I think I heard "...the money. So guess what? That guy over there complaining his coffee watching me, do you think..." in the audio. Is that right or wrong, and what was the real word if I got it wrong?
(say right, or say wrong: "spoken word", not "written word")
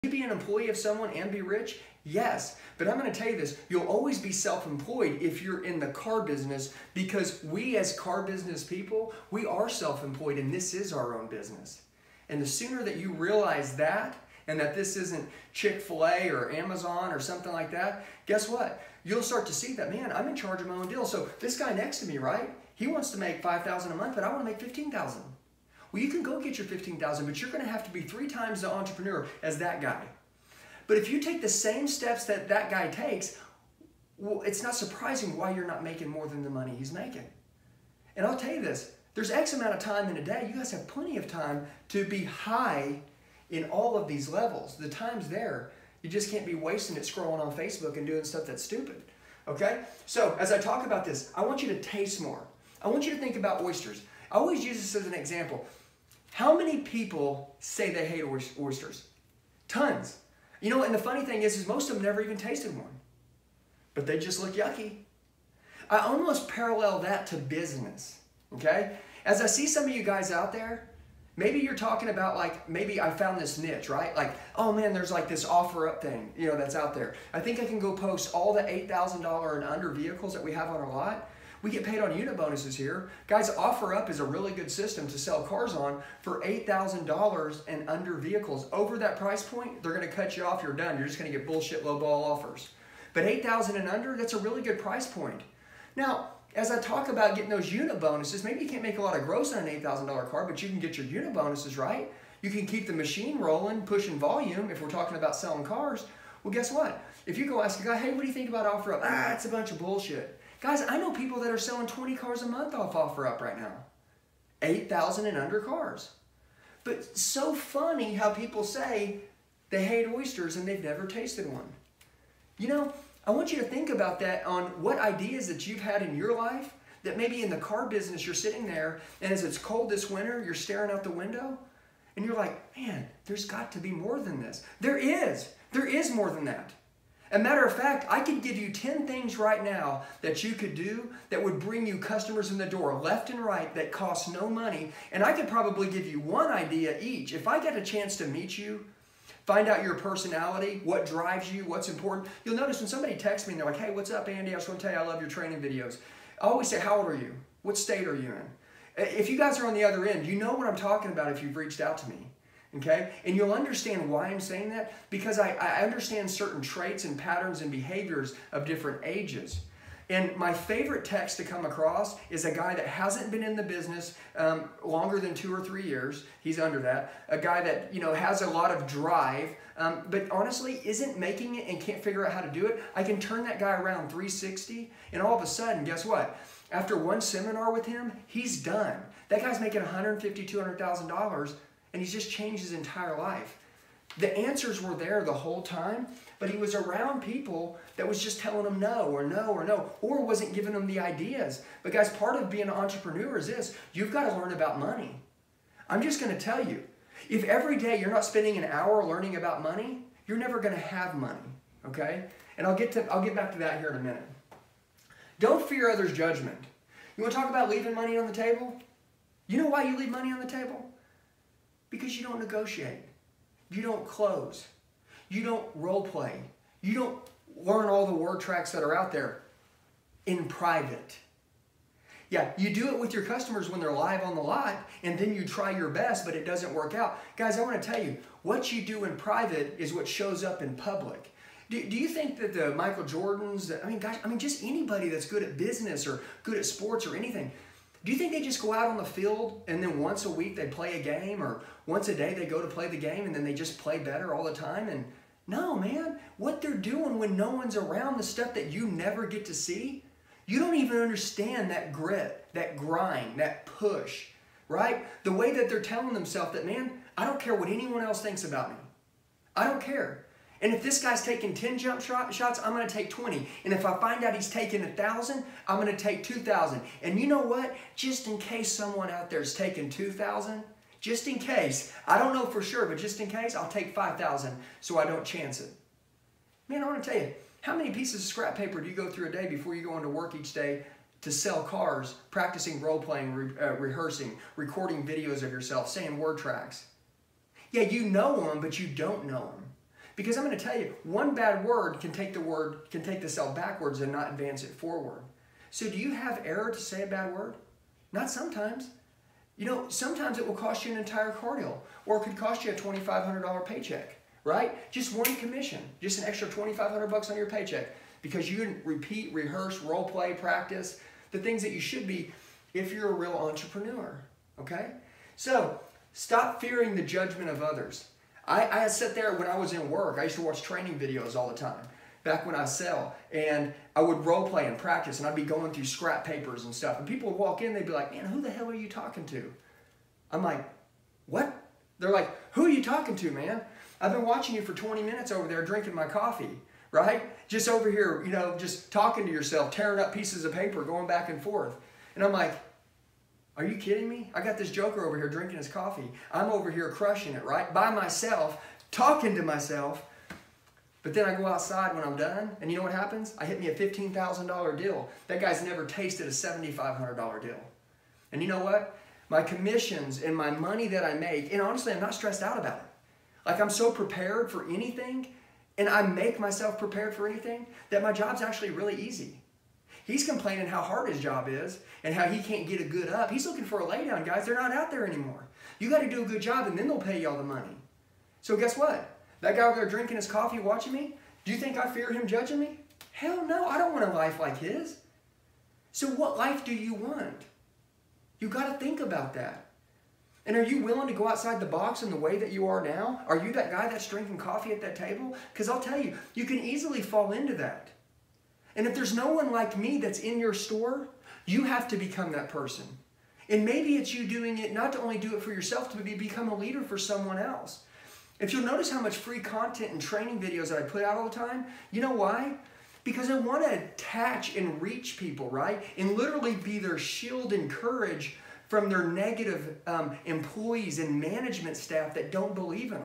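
wrong: "drinking", not "complaining".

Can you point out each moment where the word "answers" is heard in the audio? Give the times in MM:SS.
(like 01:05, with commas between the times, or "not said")
03:14.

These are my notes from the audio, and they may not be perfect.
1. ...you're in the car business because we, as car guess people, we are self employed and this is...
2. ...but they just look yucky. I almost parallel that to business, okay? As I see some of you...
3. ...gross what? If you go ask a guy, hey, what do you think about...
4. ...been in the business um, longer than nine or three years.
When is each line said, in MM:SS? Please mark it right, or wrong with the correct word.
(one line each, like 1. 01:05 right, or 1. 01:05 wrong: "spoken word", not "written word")
1. 00:05 wrong: "business", not "guess"
2. 01:03 right
3. 01:46 wrong: "guess", not "gross"
4. 02:53 wrong: "two", not "nine".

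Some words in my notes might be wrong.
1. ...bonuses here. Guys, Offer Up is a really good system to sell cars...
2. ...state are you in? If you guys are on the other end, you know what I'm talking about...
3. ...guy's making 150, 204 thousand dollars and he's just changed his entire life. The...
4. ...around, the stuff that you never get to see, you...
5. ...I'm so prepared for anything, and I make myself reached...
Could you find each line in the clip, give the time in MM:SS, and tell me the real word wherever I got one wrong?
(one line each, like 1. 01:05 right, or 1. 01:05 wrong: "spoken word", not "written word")
1. 01:22 right
2. 02:37 right
3. 03:09 wrong: "200", not "204"
4. 04:17 right
5. 06:13 wrong: "prepared", not "reached".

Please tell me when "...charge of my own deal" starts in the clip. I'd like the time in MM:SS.
00:20.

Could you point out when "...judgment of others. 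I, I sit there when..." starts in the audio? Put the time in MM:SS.
05:27.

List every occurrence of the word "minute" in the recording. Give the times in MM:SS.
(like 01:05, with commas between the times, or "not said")
03:33, 05:45.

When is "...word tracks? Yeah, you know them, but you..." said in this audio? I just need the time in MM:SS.
04:56.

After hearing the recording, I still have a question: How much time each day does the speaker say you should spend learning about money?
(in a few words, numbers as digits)
An hour.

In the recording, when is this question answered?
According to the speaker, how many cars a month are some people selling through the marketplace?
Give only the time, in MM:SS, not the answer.
01:51.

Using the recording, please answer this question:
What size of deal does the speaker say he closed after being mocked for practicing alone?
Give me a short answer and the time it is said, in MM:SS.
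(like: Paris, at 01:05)
$15,000, at 06:03.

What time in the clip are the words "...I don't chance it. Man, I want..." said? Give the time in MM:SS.
04:44.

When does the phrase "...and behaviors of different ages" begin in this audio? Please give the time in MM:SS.
02:47.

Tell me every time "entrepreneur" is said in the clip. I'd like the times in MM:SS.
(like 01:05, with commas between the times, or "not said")
00:28, 03:22, 05:23.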